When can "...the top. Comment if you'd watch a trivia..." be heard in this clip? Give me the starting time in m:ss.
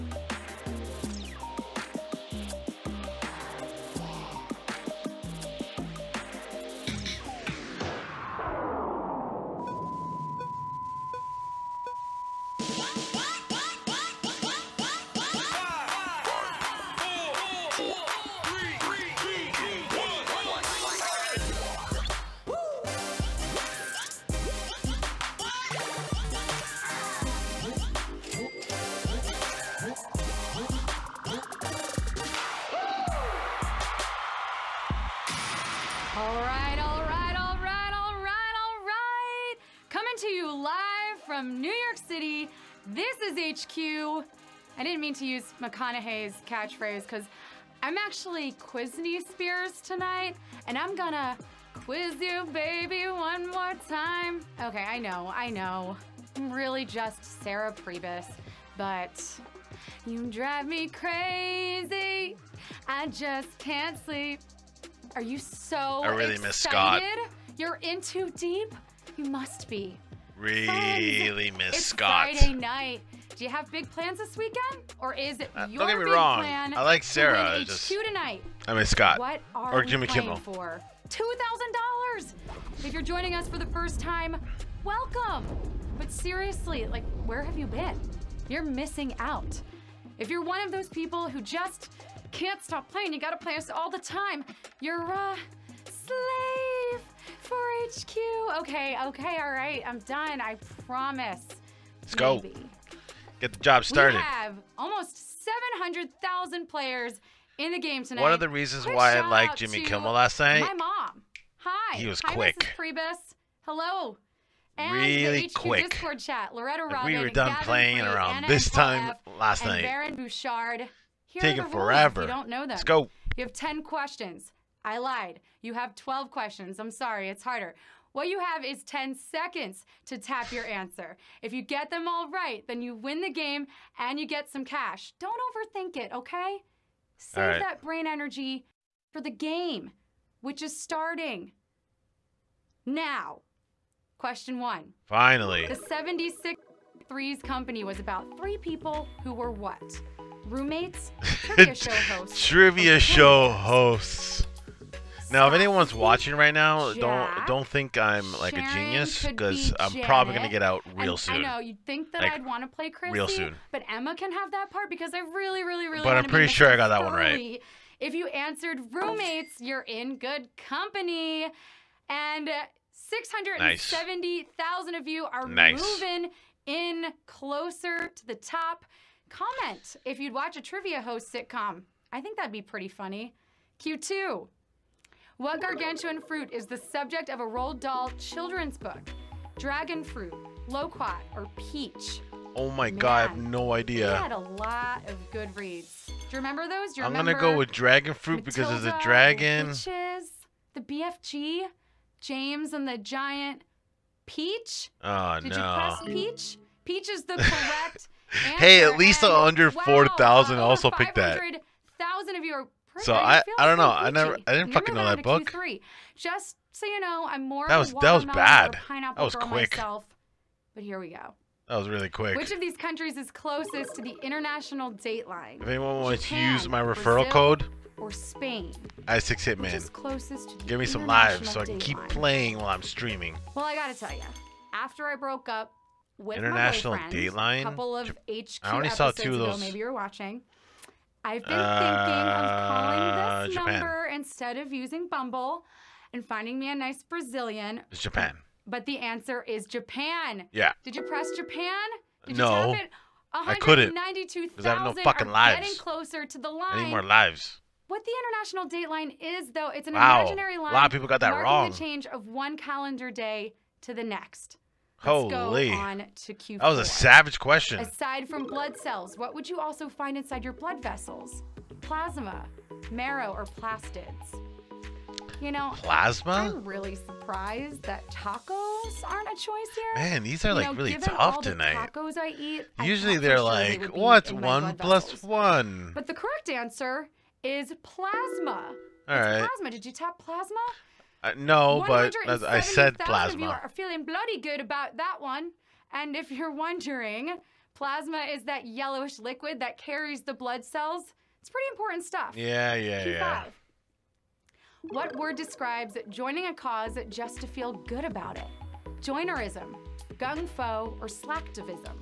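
2:58.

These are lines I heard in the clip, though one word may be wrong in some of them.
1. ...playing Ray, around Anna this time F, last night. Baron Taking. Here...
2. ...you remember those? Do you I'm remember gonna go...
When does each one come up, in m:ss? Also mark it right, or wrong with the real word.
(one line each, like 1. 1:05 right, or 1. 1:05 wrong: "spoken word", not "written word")
1. 1:57 wrong: "Bouchard", not "Taking"
2. 3:16 right.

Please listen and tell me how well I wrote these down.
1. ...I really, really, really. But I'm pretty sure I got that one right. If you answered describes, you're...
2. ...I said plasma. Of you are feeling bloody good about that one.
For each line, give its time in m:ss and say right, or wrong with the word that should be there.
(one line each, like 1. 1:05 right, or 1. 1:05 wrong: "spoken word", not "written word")
1. 2:45 wrong: "roommates", not "describes"
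2. 4:52 right.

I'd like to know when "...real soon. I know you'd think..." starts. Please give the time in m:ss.
2:40.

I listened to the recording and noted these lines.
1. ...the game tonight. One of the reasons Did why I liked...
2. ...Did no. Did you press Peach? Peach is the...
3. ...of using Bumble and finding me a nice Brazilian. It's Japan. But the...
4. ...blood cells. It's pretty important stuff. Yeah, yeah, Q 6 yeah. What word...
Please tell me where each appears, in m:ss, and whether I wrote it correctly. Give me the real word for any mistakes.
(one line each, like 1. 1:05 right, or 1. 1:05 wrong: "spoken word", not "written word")
1. 1:47 wrong: "Quick", not "Did"
2. 3:25 right
3. 4:04 right
4. 5:00 wrong: "5", not "6".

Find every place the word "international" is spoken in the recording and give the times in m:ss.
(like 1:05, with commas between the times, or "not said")
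3:44, 3:56, 4:18.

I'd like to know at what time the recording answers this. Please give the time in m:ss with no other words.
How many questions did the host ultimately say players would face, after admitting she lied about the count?
2:05.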